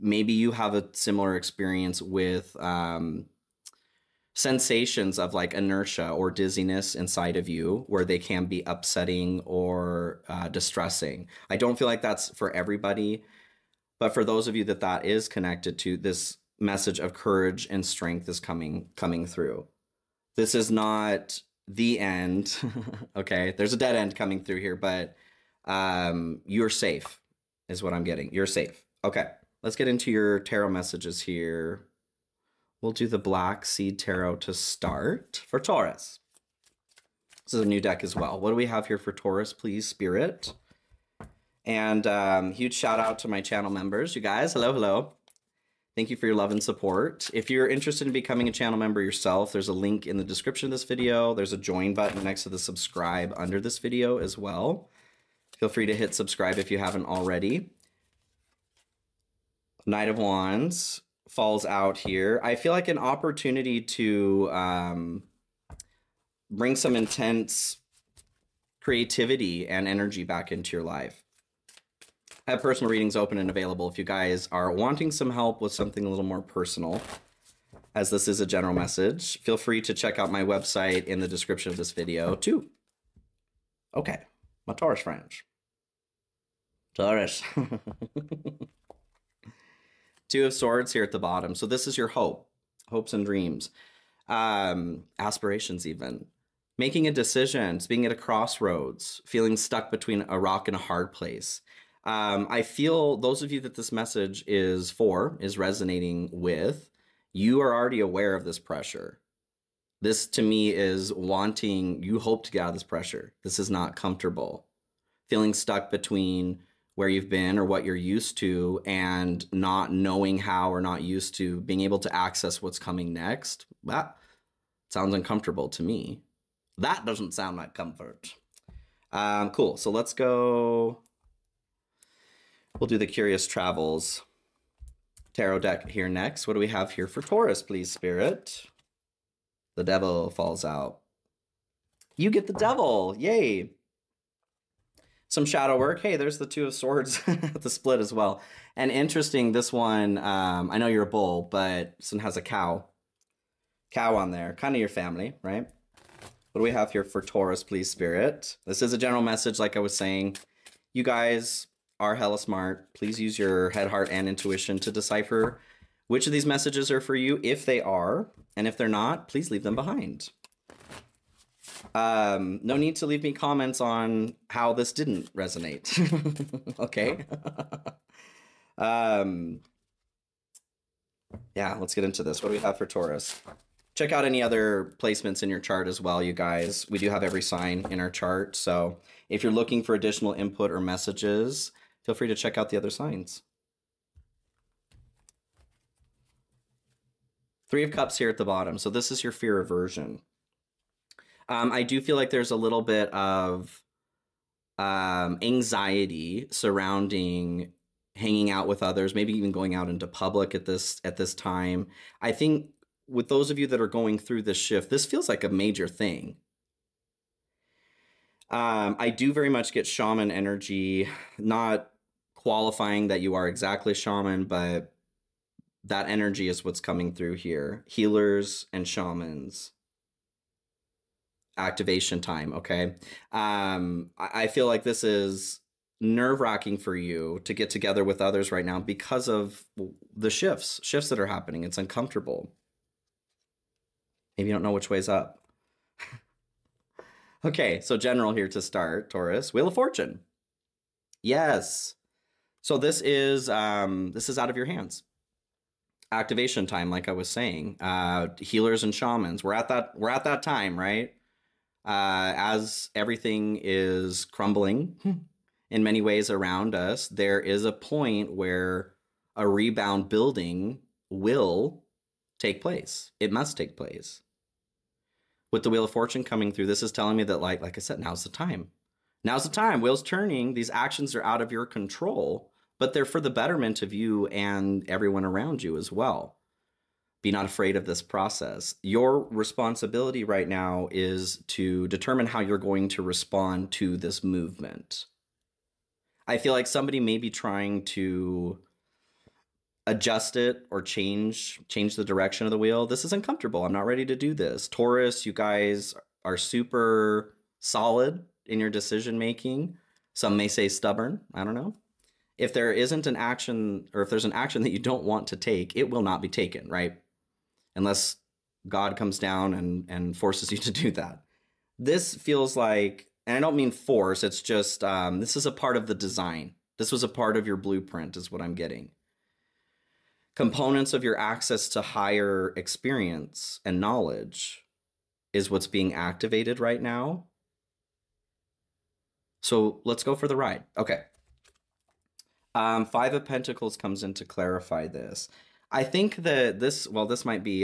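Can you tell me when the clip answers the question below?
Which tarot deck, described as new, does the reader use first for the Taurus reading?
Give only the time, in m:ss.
0:33.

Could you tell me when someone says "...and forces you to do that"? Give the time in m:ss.
5:19.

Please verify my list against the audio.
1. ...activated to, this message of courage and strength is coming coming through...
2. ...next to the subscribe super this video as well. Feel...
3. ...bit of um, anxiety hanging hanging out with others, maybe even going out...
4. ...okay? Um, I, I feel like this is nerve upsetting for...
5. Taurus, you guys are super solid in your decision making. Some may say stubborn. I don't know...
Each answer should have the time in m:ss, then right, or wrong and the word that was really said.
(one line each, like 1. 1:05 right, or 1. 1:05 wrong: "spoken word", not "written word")
1. 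0:15 wrong: "connected", not "activated"
2. 0:52 wrong: "under", not "super"
3. 3:22 wrong: "surrounding", not "hanging"
4. 3:52 wrong: "wracking", not "upsetting"
5. 5:04 right.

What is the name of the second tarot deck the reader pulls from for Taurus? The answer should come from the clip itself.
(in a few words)
Curious Travels.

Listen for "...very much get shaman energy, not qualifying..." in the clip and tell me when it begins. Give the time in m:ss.
3:39.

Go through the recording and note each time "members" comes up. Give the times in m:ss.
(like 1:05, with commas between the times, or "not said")
0:43, 0:48.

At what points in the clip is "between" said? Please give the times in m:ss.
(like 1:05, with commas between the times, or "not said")
1:39, 1:55.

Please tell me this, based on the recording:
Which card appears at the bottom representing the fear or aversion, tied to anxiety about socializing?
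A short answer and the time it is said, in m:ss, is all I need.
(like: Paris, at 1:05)
Three of Cups, at 3:17.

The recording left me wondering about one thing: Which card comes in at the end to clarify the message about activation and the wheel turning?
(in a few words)
Five of Pentacles.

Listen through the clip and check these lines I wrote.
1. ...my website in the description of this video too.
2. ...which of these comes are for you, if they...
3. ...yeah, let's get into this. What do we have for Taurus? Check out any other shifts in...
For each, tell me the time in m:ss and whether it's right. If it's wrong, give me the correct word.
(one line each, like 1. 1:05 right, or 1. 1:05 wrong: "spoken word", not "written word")
1. 1:20 right
2. 2:46 wrong: "messages", not "comes"
3. 3:01 wrong: "placements", not "shifts".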